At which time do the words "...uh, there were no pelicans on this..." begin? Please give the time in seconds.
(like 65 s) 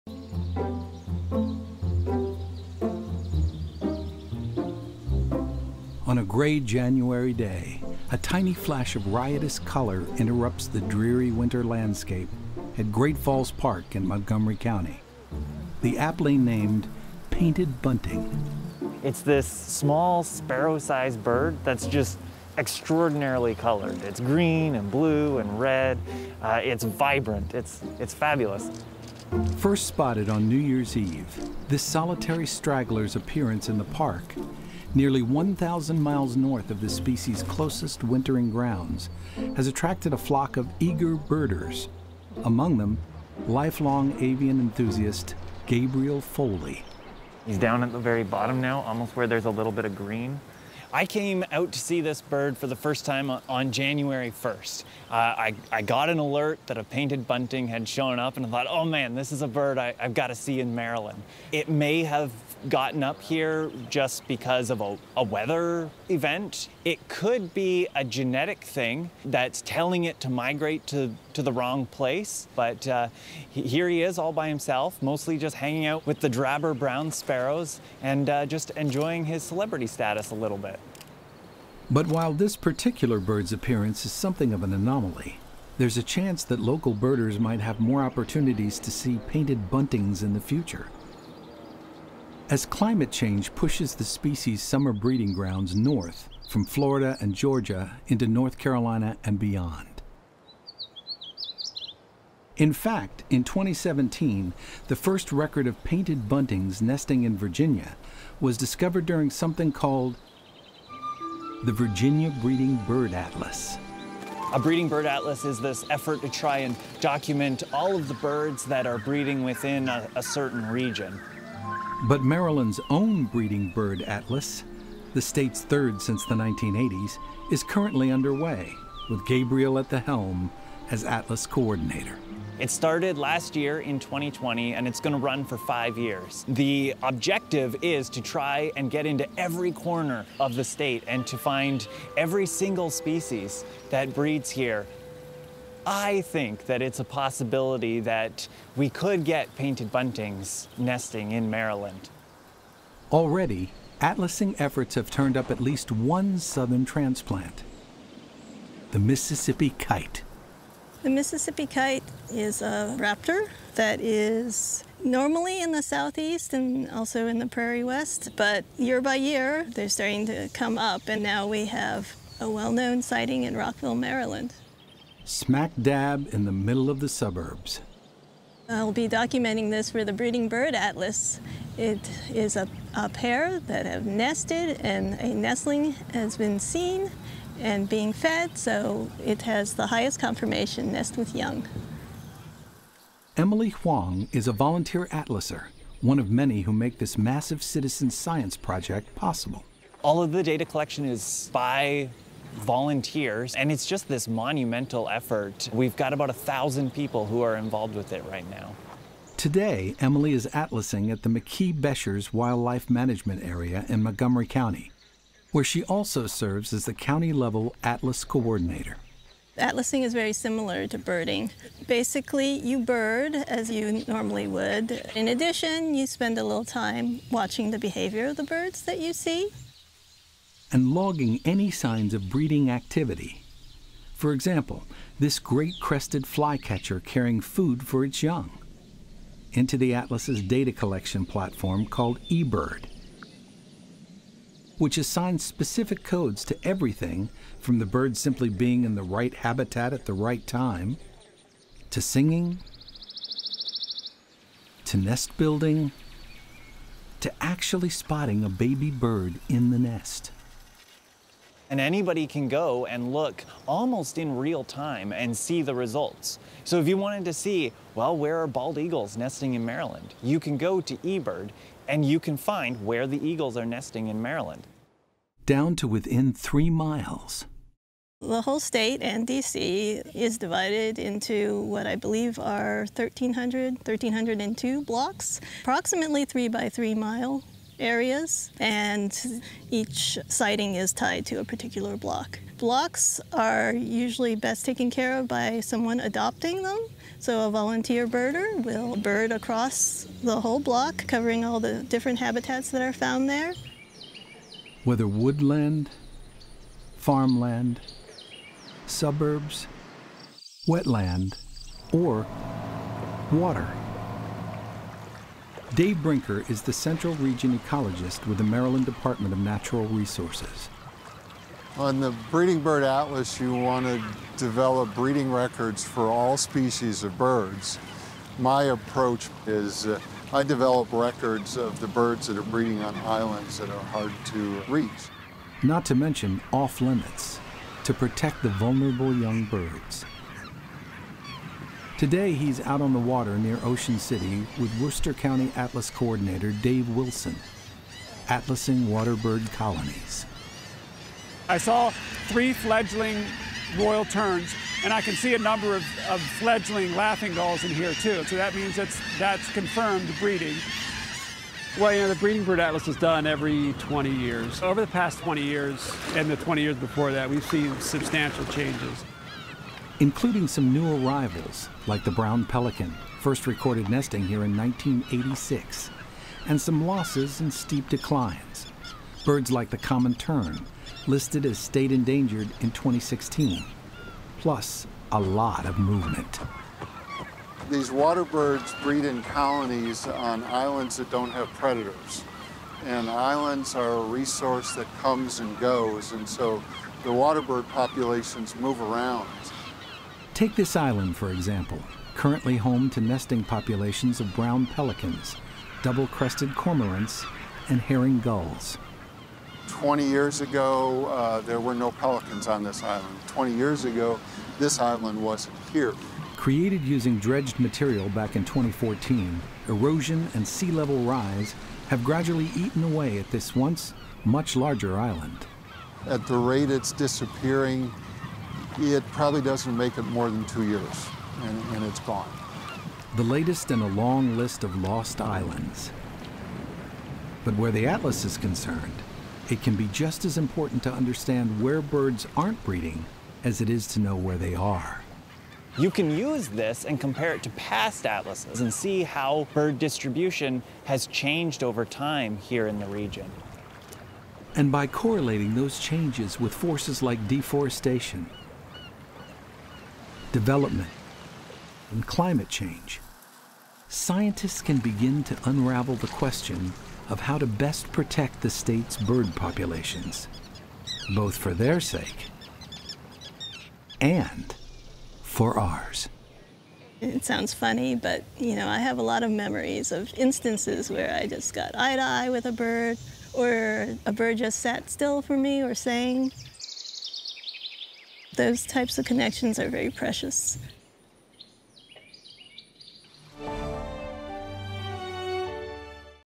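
411 s.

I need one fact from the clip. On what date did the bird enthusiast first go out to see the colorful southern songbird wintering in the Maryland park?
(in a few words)
January 1st.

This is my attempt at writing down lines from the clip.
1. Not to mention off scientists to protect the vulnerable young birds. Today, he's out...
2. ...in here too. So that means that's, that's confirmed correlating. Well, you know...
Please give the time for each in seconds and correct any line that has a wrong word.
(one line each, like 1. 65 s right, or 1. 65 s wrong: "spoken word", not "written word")
1. 335 s wrong: "limits", not "scientists"
2. 357 s wrong: "breeding", not "correlating".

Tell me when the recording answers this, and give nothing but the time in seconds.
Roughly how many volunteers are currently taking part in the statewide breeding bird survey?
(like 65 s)
206 s.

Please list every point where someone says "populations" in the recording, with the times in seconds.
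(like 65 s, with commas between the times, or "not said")
397 s, 403 s, 469 s.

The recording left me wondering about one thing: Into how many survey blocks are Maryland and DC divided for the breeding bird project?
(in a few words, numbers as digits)
1,302.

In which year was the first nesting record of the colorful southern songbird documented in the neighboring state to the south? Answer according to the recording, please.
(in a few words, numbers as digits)
2017.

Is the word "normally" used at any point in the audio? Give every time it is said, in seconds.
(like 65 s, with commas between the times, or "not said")
165 s, 224 s.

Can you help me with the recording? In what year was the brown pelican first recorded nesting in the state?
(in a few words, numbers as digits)
1986.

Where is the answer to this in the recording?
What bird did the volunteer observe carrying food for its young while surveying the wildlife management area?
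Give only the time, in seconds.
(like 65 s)
235 s.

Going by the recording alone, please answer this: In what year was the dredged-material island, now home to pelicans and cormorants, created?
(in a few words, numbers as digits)
2014.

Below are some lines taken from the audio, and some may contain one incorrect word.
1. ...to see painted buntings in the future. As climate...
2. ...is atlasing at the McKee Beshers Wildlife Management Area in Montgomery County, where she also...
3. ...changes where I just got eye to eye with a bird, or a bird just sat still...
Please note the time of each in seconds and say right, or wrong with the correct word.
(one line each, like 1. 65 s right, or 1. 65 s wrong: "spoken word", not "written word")
1. 88 s right
2. 210 s right
3. 480 s wrong: "instances", not "changes".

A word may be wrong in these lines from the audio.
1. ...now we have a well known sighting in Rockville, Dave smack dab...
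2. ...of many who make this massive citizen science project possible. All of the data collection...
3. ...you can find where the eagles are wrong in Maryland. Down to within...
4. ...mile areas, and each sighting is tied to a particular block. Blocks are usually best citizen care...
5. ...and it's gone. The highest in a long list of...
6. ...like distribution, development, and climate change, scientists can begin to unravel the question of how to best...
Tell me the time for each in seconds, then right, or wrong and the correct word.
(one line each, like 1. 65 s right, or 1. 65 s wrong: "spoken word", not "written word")
1. 171 s wrong: "Maryland", not "Dave"
2. 196 s right
3. 272 s wrong: "nesting", not "wrong"
4. 286 s wrong: "taken", not "citizen"
5. 431 s wrong: "latest", not "highest"
6. 457 s wrong: "deforestation", not "distribution".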